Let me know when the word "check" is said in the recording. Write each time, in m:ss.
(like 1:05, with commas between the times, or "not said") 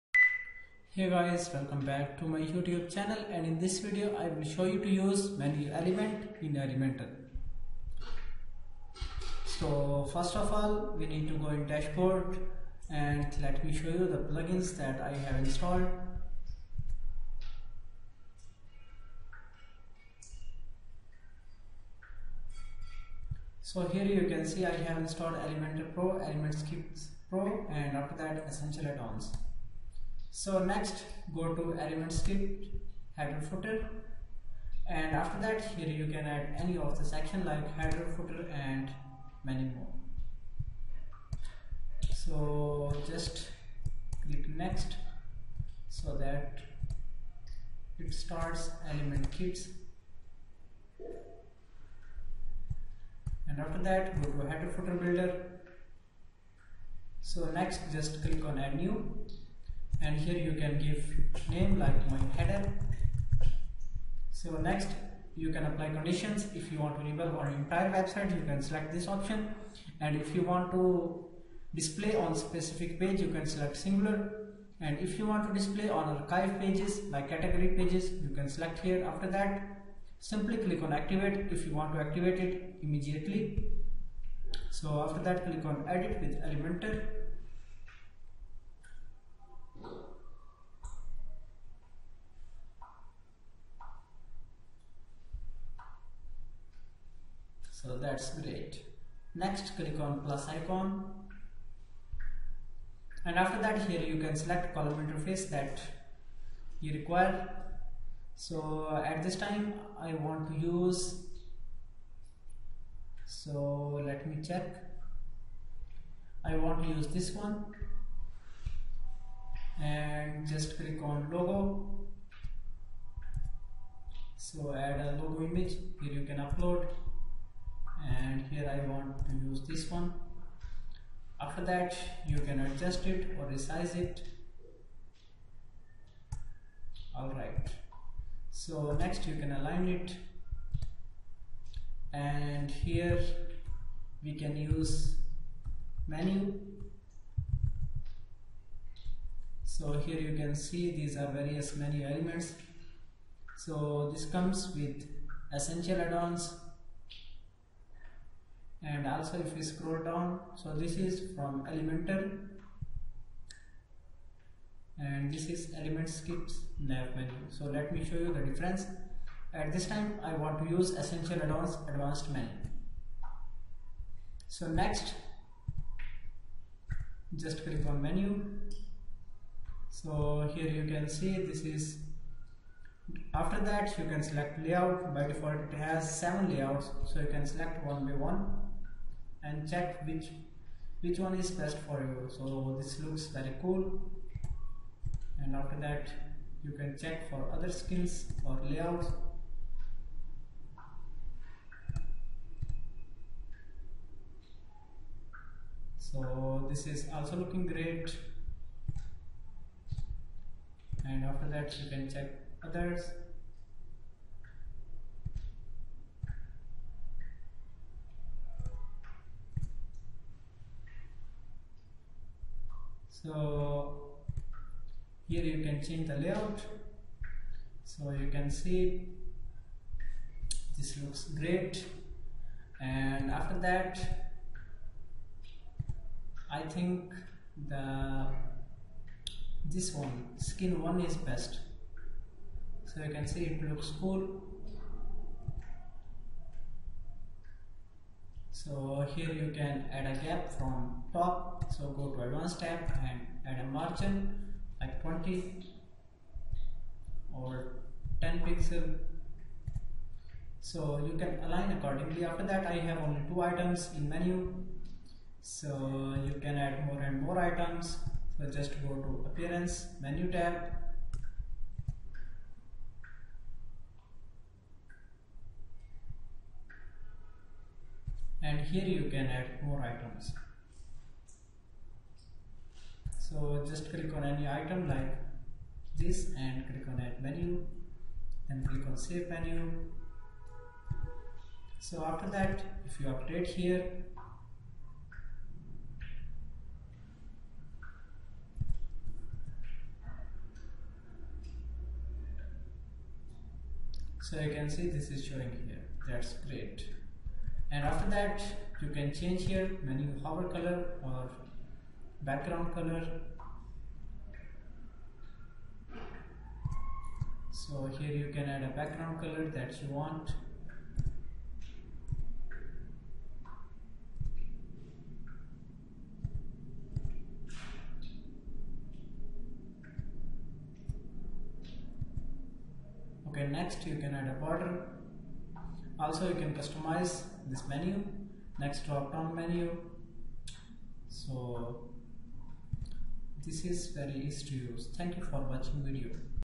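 1:54, 3:09, 3:17, 3:32.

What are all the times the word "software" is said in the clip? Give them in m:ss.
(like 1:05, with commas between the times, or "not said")
not said.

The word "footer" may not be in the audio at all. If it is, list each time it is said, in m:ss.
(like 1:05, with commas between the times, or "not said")
0:33, 0:38, 0:54.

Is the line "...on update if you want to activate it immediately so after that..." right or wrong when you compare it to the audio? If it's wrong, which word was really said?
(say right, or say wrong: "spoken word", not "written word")
wrong: "activate", not "update".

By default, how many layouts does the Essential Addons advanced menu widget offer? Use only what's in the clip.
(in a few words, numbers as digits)
7.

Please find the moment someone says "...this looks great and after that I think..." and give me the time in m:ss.
3:50.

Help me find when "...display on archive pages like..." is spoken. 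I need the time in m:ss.
1:15.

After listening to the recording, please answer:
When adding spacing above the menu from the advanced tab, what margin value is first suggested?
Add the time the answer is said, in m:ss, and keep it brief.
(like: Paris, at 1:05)
20 pixels, at 4:15.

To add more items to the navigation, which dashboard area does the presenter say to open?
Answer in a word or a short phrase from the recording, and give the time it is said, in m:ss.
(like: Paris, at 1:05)
appearance menu tab, at 4:29.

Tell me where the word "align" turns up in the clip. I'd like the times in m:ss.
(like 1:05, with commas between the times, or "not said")
2:19, 4:21.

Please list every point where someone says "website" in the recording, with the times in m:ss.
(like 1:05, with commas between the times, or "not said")
1:07.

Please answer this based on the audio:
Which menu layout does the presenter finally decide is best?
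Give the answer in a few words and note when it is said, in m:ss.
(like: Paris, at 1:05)
skin one, at 4:00.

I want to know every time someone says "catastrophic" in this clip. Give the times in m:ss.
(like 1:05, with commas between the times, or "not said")
not said.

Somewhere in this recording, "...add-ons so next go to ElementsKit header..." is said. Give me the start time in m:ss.
0:28.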